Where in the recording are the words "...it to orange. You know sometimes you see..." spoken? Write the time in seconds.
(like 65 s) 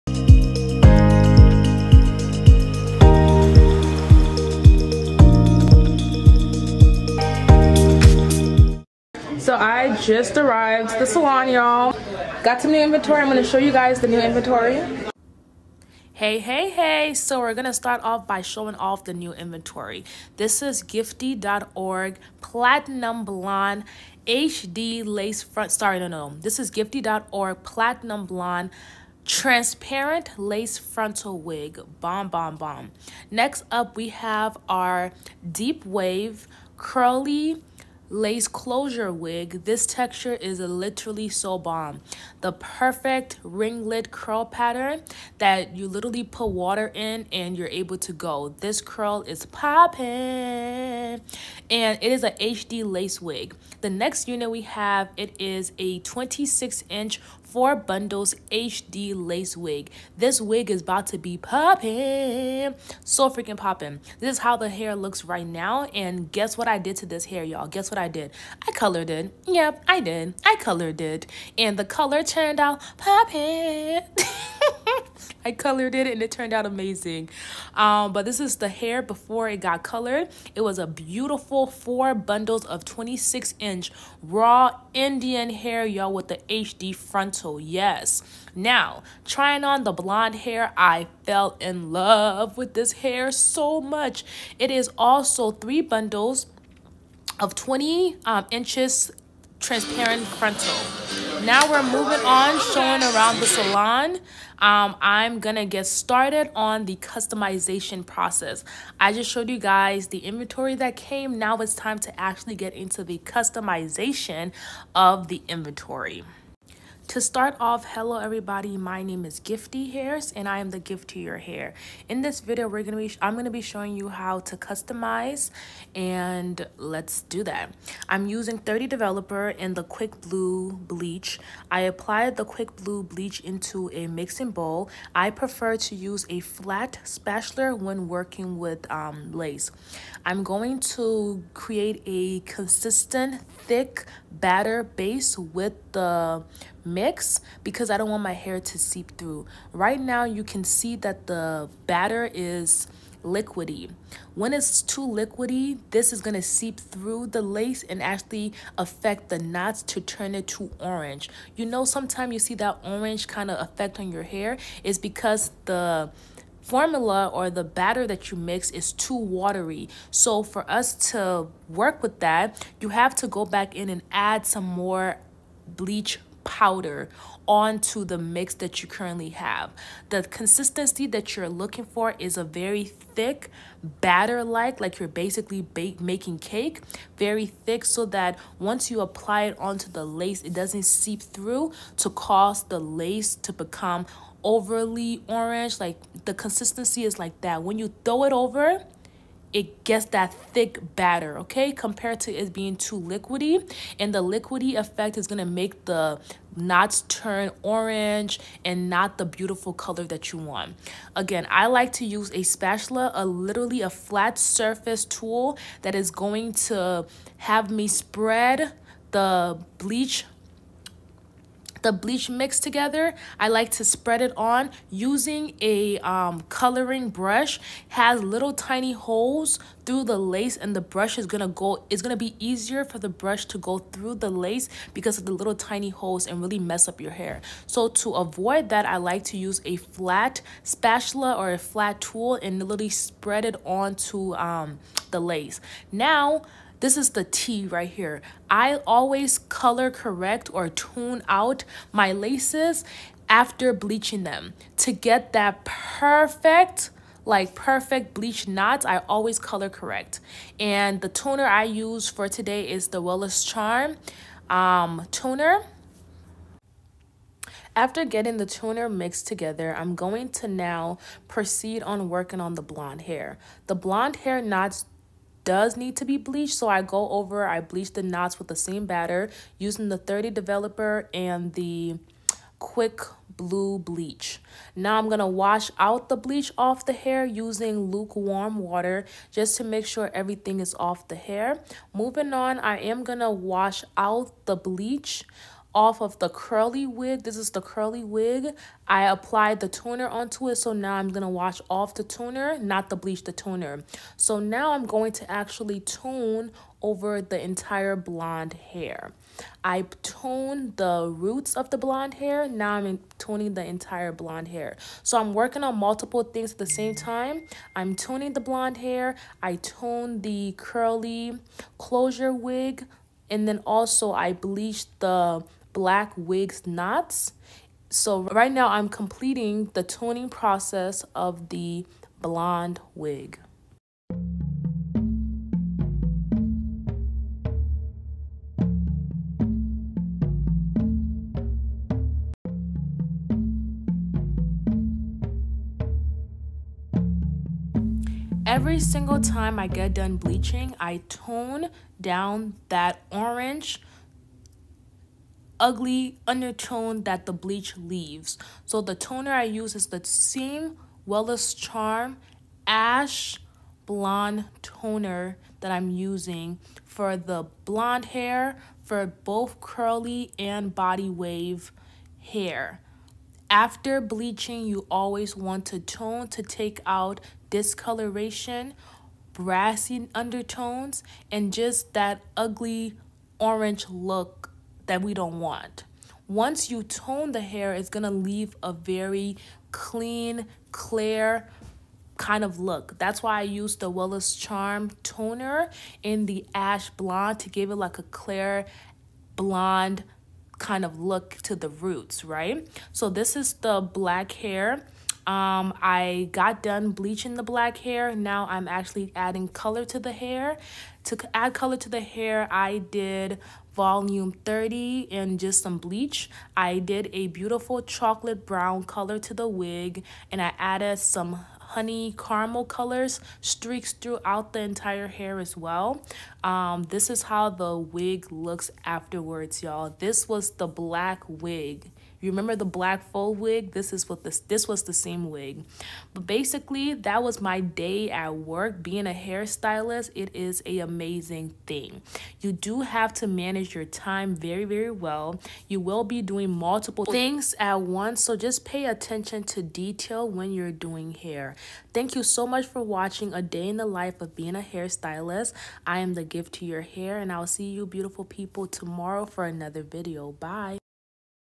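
160 s.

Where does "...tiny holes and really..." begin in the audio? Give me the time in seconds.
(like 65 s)
235 s.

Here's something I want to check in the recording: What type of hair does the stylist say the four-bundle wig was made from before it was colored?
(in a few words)
raw Indian hair.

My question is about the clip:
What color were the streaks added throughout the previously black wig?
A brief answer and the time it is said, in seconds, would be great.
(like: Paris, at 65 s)
honey caramel, at 421 s.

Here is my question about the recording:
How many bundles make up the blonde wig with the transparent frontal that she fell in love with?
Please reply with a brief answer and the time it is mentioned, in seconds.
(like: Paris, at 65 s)
3, at 95 s.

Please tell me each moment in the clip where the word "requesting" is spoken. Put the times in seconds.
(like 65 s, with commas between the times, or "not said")
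not said.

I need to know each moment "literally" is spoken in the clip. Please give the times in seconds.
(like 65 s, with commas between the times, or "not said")
40 s, 45 s, 213 s, 242 s.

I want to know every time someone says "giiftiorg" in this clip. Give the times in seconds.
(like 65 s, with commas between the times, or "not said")
20 s, 26 s.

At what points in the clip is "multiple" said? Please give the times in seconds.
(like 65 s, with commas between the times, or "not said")
315 s, 446 s.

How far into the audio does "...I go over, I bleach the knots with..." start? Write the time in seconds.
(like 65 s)
276 s.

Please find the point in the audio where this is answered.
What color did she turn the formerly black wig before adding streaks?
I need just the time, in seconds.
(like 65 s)
417 s.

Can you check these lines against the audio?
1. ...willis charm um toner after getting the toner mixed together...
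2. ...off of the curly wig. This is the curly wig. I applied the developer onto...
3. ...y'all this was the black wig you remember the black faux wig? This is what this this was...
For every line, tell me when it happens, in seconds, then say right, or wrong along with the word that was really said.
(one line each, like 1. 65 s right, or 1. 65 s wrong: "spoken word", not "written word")
1. 262 s right
2. 295 s wrong: "toner", not "developer"
3. 429 s right.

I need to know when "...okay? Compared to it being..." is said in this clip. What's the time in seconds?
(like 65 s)
201 s.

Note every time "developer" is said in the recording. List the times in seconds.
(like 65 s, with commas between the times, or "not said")
128 s, 280 s.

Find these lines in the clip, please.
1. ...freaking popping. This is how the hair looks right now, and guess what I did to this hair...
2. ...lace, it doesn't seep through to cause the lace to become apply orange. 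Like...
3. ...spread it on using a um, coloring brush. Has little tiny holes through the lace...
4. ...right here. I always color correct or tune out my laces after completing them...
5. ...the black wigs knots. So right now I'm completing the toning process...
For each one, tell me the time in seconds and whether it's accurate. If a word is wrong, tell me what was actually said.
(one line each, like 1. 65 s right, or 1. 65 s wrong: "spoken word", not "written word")
1. 63 s right
2. 190 s wrong: "overly", not "apply"
3. 223 s right
4. 247 s wrong: "bleaching", not "completing"
5. 324 s right.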